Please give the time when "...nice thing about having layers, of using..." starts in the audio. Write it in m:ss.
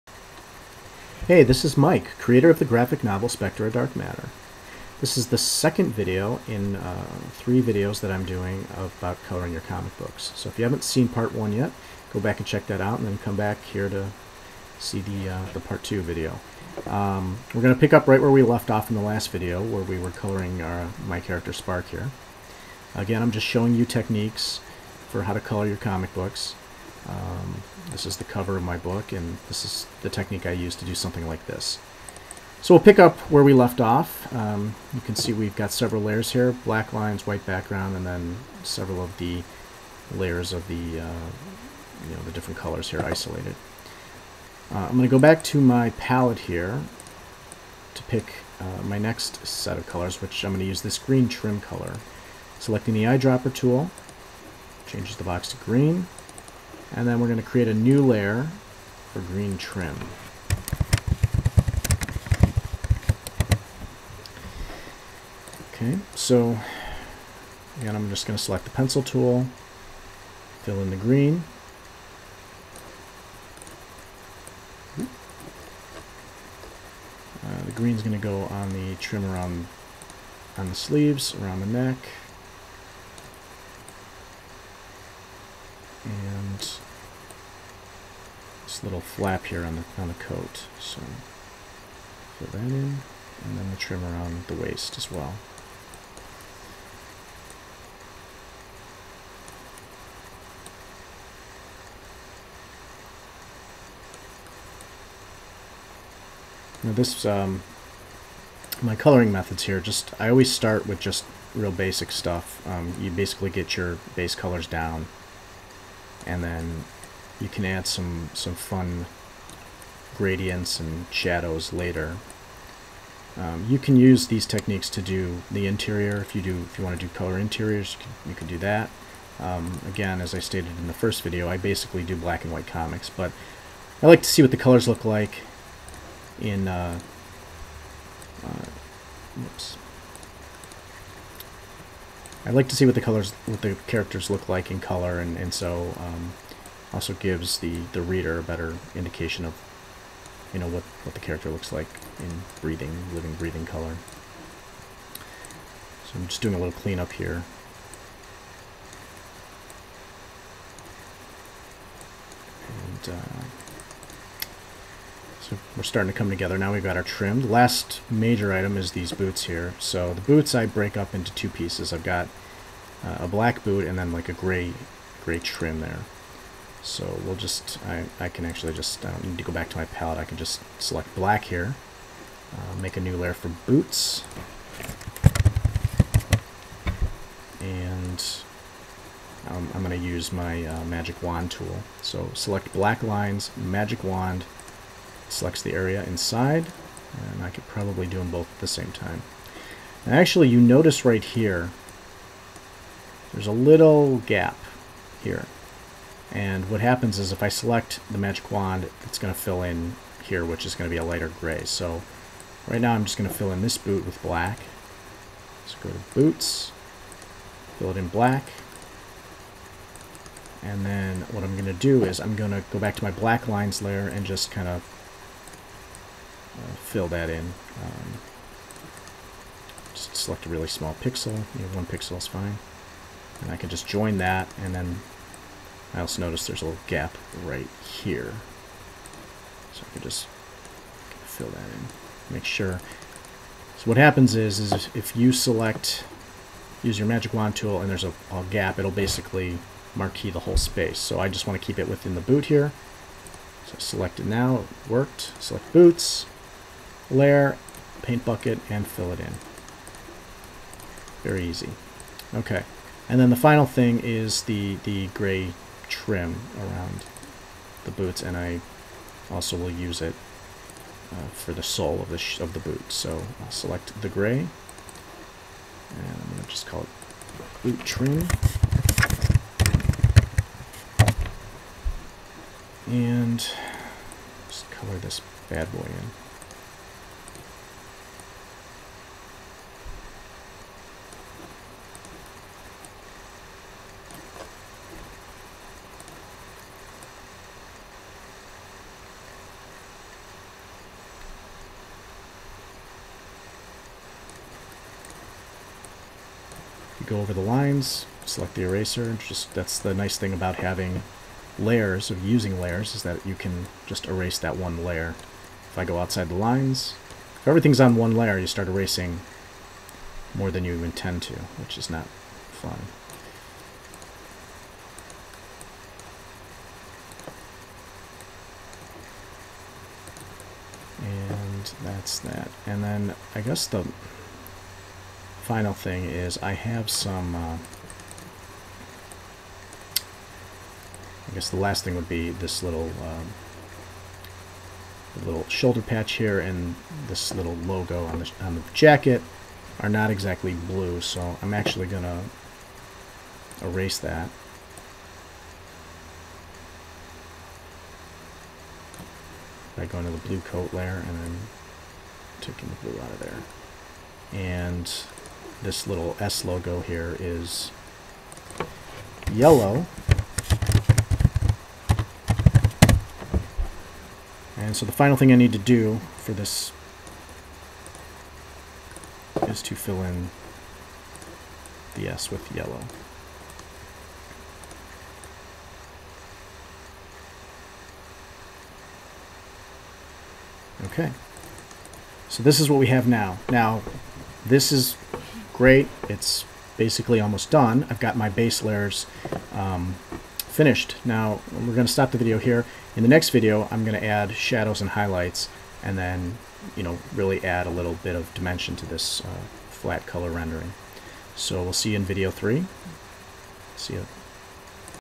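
5:09.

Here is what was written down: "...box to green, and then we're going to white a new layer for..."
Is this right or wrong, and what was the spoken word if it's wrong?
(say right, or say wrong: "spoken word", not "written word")
wrong: "create", not "white".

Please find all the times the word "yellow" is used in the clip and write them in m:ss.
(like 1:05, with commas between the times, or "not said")
6:09, 6:22.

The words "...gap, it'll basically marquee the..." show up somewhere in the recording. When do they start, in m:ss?
4:08.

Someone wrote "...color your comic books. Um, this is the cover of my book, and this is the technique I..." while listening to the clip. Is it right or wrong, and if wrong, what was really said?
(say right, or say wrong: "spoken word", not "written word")
right.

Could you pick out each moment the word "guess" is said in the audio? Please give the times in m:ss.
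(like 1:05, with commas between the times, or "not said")
5:33, 5:41.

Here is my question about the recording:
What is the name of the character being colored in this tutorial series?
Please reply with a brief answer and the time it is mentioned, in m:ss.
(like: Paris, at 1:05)
Spark, at 0:21.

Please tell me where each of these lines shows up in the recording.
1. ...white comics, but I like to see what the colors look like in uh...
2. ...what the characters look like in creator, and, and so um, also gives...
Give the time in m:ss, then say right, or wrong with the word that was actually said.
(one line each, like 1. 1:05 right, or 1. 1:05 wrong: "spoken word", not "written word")
1. 2:12 right
2. 2:23 wrong: "color", not "creator".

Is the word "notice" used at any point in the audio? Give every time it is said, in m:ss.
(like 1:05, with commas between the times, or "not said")
3:20, 3:56.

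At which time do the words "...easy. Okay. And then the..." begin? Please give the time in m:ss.
4:21.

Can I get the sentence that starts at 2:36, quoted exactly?
So I'm just doing a little cleanup here.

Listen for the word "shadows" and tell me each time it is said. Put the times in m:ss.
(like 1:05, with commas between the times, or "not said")
2:01, 6:44.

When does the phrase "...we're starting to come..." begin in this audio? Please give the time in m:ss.
2:45.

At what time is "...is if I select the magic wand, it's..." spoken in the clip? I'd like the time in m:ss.
3:27.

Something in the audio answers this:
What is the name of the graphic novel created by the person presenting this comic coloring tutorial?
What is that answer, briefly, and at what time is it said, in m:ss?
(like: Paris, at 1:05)
Dark Matter, at 0:03.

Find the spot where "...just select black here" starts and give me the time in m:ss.
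3:00.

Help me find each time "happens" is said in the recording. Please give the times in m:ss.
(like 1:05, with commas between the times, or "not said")
3:26, 4:03.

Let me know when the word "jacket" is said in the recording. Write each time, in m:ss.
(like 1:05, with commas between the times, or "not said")
5:48.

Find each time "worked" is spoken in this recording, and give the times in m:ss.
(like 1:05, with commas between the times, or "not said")
4:14.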